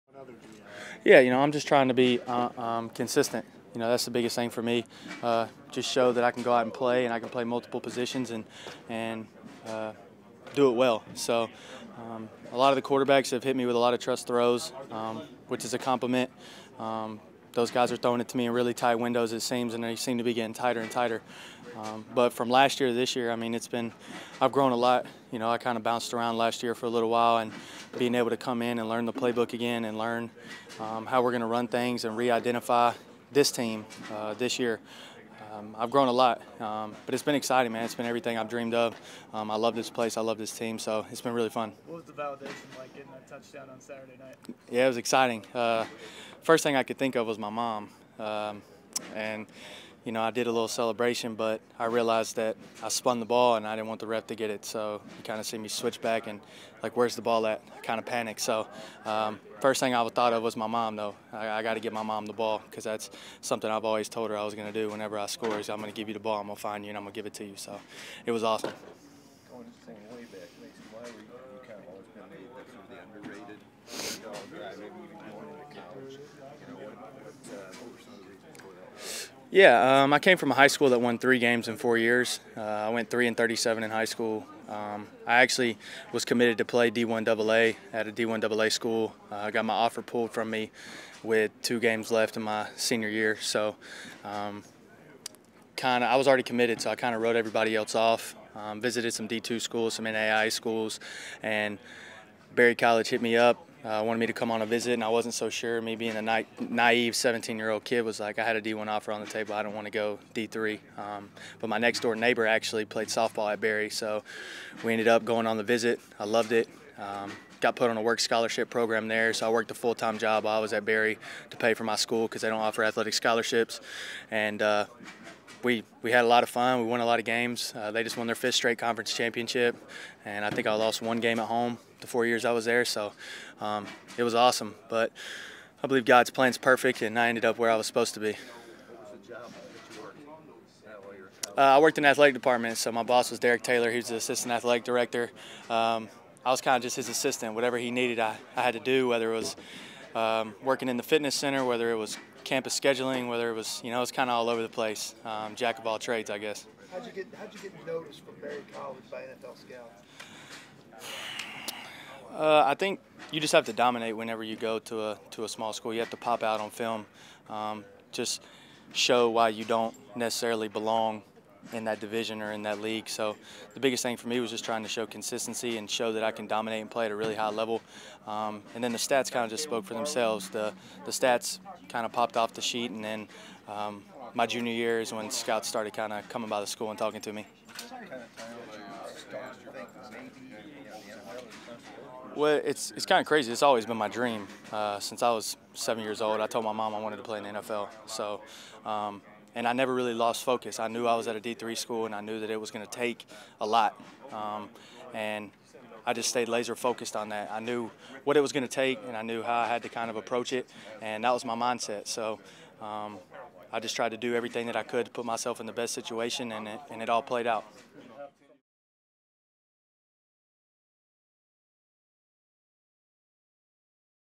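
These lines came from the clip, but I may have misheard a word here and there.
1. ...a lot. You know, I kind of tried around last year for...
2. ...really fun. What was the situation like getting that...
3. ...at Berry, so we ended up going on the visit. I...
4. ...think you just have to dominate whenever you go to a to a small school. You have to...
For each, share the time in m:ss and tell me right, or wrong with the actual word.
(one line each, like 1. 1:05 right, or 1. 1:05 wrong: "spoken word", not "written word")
1. 0:24 wrong: "bounced", not "tried"
2. 0:41 wrong: "validation", not "situation"
3. 1:53 right
4. 2:42 right.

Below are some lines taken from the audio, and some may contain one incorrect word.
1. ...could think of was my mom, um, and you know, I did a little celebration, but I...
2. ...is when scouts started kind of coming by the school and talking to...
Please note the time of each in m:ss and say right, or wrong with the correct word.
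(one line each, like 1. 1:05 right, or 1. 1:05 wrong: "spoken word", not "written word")
1. 0:46 right
2. 3:05 right.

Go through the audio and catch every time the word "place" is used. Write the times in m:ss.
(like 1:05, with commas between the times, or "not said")
0:39, 2:34.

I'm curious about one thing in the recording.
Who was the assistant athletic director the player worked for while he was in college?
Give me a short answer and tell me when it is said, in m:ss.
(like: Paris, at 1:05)
Derek Taylor, at 2:23.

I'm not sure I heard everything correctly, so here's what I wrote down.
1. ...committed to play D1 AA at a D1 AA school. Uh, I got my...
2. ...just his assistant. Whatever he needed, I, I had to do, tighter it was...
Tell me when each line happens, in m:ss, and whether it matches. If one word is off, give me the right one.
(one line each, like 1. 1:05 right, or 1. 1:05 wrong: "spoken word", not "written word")
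1. 1:26 right
2. 2:26 wrong: "whether", not "tighter".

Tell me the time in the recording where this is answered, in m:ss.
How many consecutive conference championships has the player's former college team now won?
2:08.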